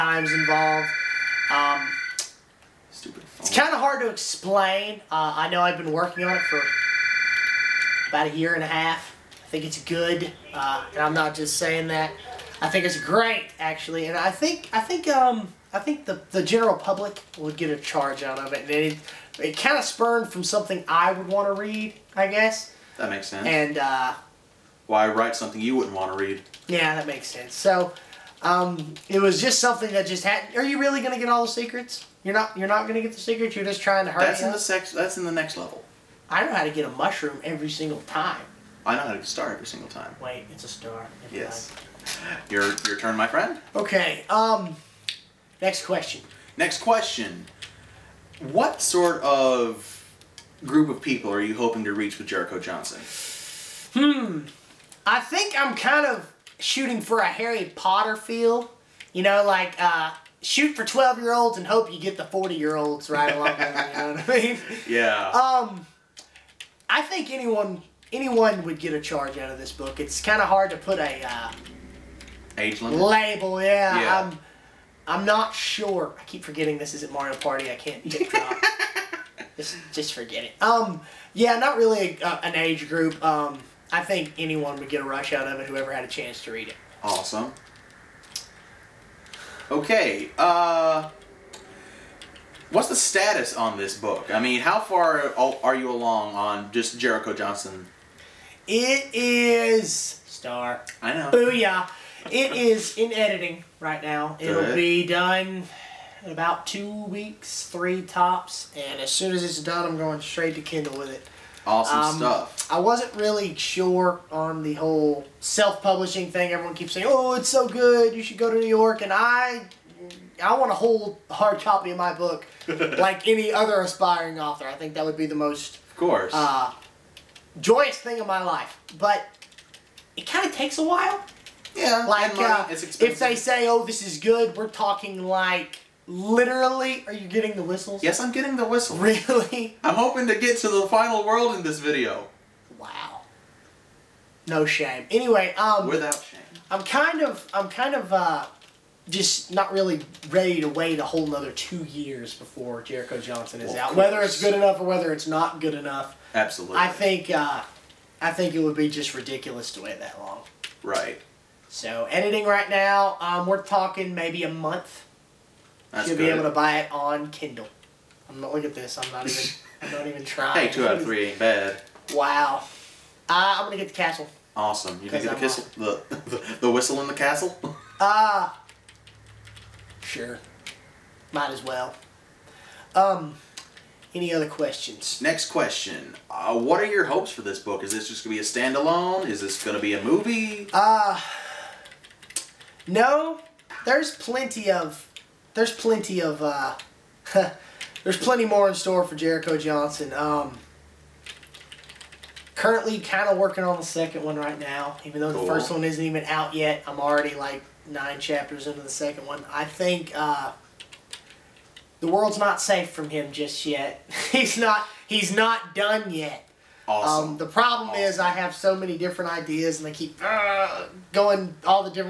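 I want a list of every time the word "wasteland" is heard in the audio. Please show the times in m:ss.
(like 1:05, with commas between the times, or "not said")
not said.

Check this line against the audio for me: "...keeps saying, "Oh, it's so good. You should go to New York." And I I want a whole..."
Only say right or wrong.
right.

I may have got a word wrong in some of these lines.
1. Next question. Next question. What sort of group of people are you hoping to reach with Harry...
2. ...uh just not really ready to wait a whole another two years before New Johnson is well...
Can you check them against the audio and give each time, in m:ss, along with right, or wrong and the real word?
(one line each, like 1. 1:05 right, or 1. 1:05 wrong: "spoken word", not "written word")
1. 0:45 wrong: "Jericho", not "Harry"
2. 2:28 wrong: "Jericho", not "New".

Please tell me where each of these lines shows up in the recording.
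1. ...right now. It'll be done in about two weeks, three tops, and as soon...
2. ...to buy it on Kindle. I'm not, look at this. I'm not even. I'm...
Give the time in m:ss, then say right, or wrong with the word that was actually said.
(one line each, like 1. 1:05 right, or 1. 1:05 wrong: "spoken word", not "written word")
1. 1:43 right
2. 2:46 right.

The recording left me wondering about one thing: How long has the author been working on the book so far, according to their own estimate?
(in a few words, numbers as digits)
a year and a half.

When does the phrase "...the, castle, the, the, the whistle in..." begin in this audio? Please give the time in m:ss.
2:55.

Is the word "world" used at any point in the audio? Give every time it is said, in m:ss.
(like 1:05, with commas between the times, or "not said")
2:21, 3:32.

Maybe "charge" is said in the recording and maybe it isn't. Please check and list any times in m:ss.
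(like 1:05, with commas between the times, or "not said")
0:17, 1:09.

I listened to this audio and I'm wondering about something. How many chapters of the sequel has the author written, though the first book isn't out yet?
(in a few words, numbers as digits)
9.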